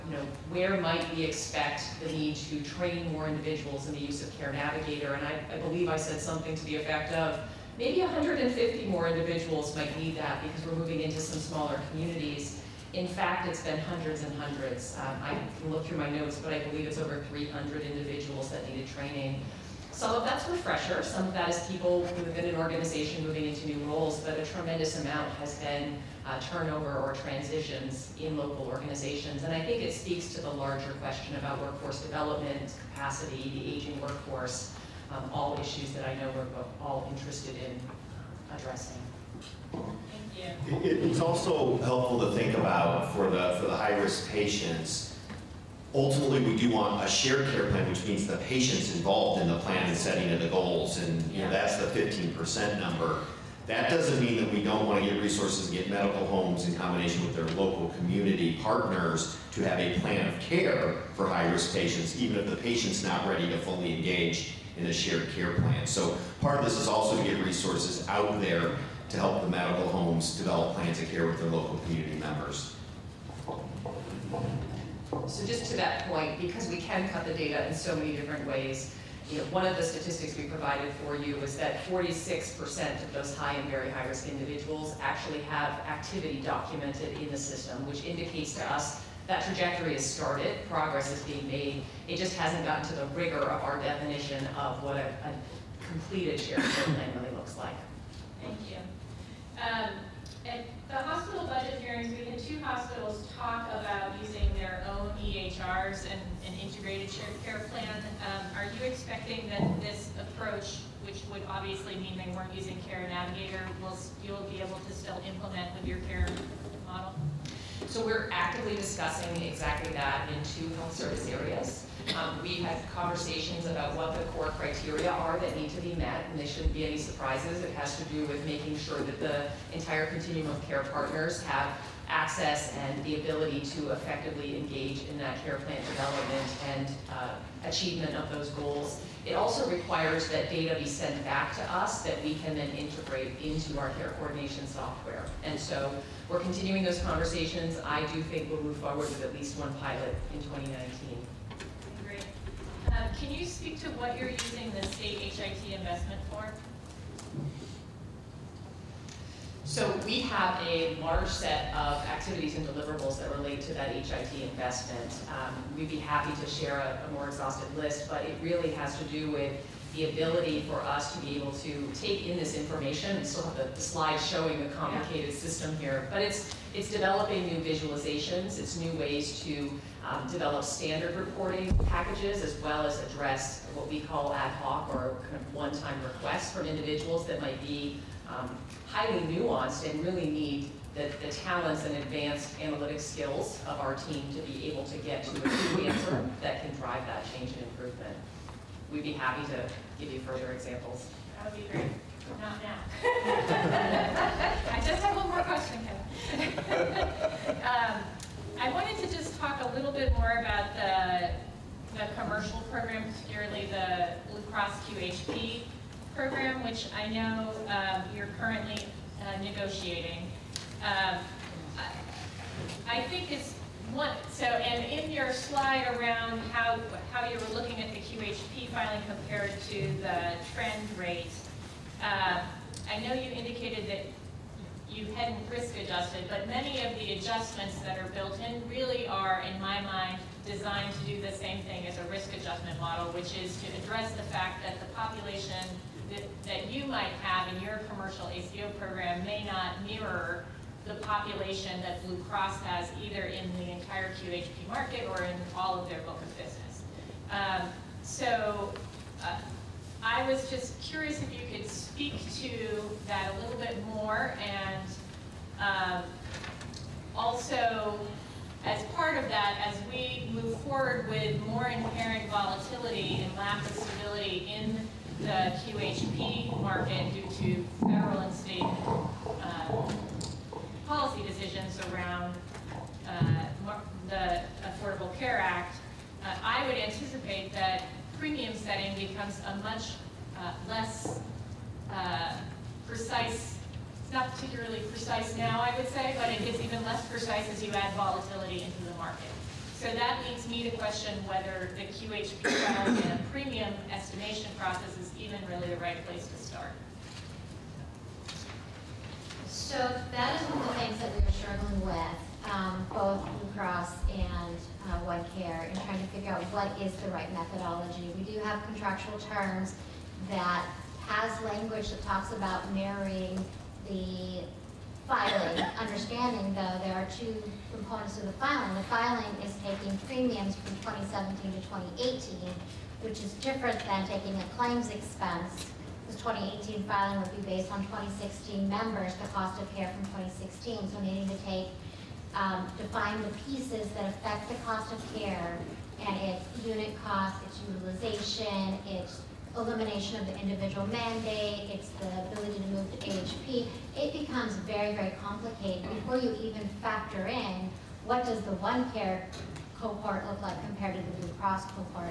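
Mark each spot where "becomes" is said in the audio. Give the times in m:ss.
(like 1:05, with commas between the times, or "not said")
4:48, 5:54.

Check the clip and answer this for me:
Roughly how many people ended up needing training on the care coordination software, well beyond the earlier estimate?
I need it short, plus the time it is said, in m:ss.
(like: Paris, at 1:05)
over 300, at 0:16.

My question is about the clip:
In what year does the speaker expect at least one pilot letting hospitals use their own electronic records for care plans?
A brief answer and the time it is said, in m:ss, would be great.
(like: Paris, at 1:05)
2019, at 2:30.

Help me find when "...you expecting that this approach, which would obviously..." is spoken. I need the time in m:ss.
1:48.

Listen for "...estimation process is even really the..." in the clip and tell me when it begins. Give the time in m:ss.
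5:03.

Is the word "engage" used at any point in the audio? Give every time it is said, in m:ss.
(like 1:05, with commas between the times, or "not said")
1:03, 2:14.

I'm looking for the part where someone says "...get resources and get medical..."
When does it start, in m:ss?
0:55.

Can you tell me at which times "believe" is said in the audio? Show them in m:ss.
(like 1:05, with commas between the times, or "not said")
0:05, 0:16.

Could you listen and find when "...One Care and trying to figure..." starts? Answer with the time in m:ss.
5:15.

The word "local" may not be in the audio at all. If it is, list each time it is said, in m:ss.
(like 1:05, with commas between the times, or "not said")
0:28, 0:57, 1:11.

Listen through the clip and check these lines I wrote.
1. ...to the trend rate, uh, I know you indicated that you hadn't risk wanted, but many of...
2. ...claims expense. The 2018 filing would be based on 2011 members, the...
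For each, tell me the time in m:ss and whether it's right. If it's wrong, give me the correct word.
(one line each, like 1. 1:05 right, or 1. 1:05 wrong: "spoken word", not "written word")
1. 3:49 wrong: "adjusted", not "wanted"
2. 5:34 wrong: "2016", not "2011".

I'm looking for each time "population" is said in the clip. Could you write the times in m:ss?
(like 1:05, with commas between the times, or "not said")
4:04, 4:10.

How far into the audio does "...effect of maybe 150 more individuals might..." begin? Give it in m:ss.
0:06.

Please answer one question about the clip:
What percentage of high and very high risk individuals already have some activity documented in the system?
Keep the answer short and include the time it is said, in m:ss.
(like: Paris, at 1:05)
46%, at 1:21.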